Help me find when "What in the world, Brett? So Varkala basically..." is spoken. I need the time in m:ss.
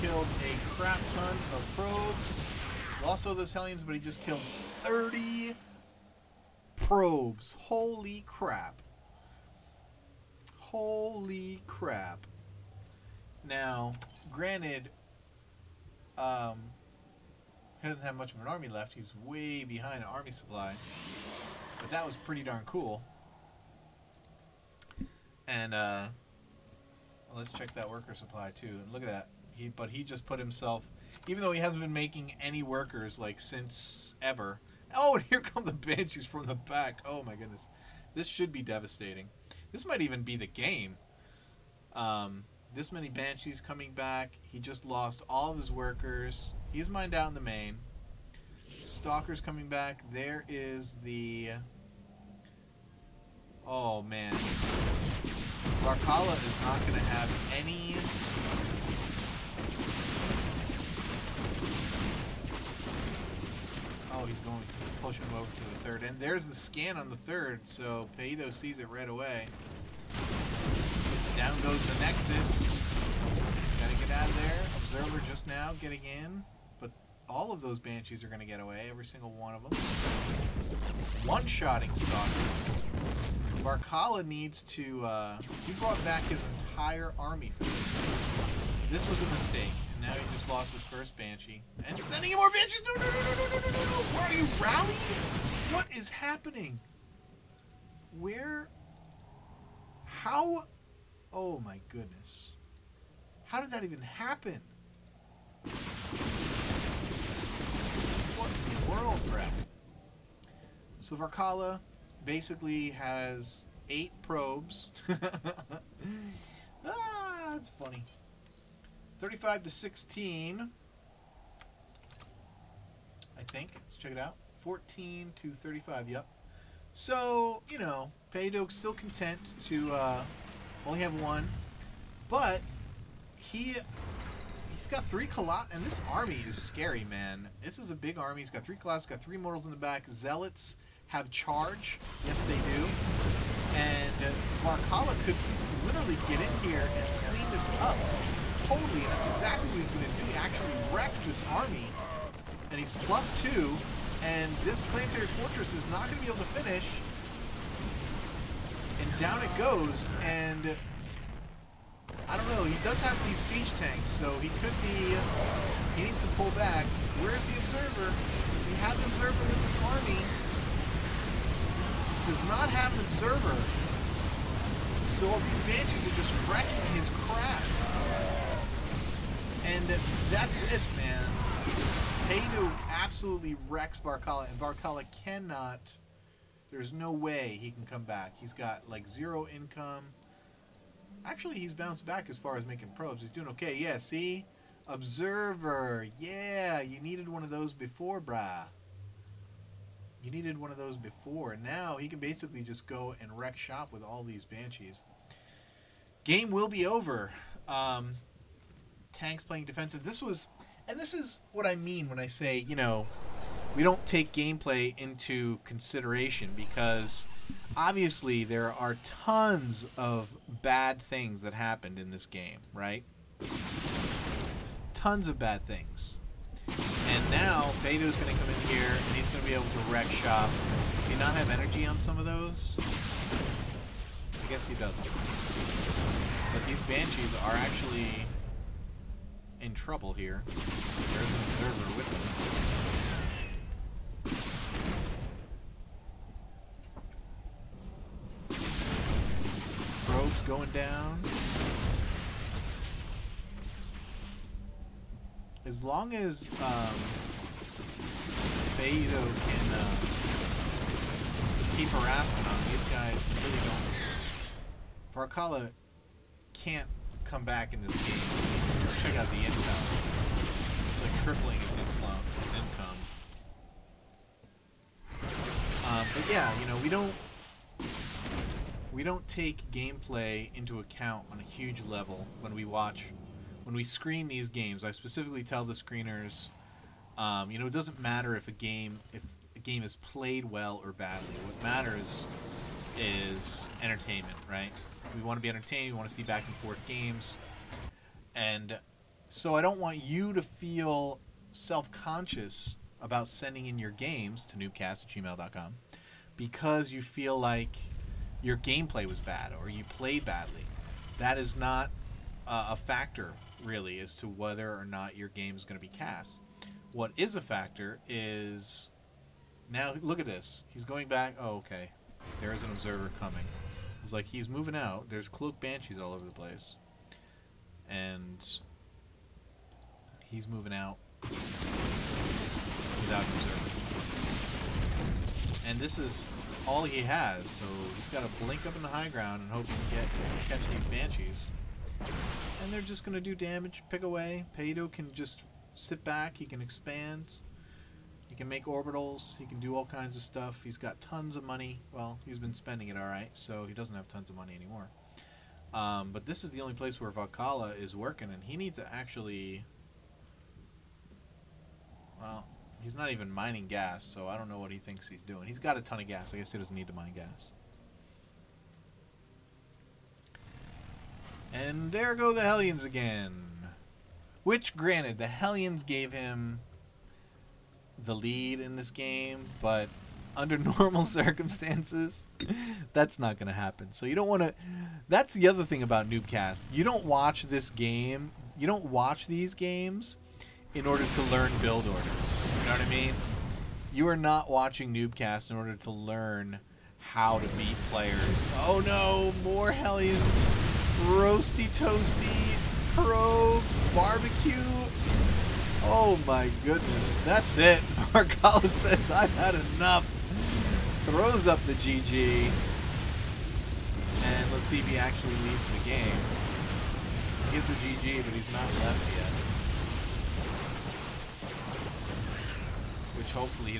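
1:48.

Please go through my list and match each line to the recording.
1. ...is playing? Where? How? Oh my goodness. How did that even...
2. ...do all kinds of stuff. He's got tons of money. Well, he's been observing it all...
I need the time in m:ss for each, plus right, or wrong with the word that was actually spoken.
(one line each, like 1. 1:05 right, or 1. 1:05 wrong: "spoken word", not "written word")
1. 1:35 wrong: "happening", not "playing"
2. 5:49 wrong: "spending", not "observing".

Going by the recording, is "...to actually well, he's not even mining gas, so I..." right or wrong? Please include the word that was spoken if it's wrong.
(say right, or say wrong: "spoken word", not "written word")
right.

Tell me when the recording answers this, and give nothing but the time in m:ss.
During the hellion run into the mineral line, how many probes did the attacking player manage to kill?
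0:04.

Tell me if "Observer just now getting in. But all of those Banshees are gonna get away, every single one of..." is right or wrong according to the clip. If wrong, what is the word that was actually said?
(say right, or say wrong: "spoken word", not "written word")
right.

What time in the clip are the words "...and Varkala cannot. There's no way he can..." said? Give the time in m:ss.
3:04.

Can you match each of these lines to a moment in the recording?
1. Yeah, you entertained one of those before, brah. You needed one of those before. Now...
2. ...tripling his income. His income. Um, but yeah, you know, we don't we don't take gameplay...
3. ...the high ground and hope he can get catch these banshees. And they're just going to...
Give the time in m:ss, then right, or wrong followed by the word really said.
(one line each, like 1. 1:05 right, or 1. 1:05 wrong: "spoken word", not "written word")
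1. 3:16 wrong: "needed", not "entertained"
2. 4:31 right
3. 5:38 right.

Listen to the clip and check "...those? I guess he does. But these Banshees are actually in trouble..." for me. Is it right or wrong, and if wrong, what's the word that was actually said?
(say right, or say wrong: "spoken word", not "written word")
right.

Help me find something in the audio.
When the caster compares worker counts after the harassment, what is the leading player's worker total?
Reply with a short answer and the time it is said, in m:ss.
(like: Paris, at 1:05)
35, at 1:59.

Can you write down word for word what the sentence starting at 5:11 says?
That is not uh, a factor, really, as to whether or not your game is going to be cast.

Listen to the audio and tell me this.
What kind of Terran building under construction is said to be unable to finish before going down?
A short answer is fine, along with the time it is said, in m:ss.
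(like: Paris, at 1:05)
Planetary fortress, at 2:34.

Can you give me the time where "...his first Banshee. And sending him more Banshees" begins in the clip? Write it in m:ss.
1:30.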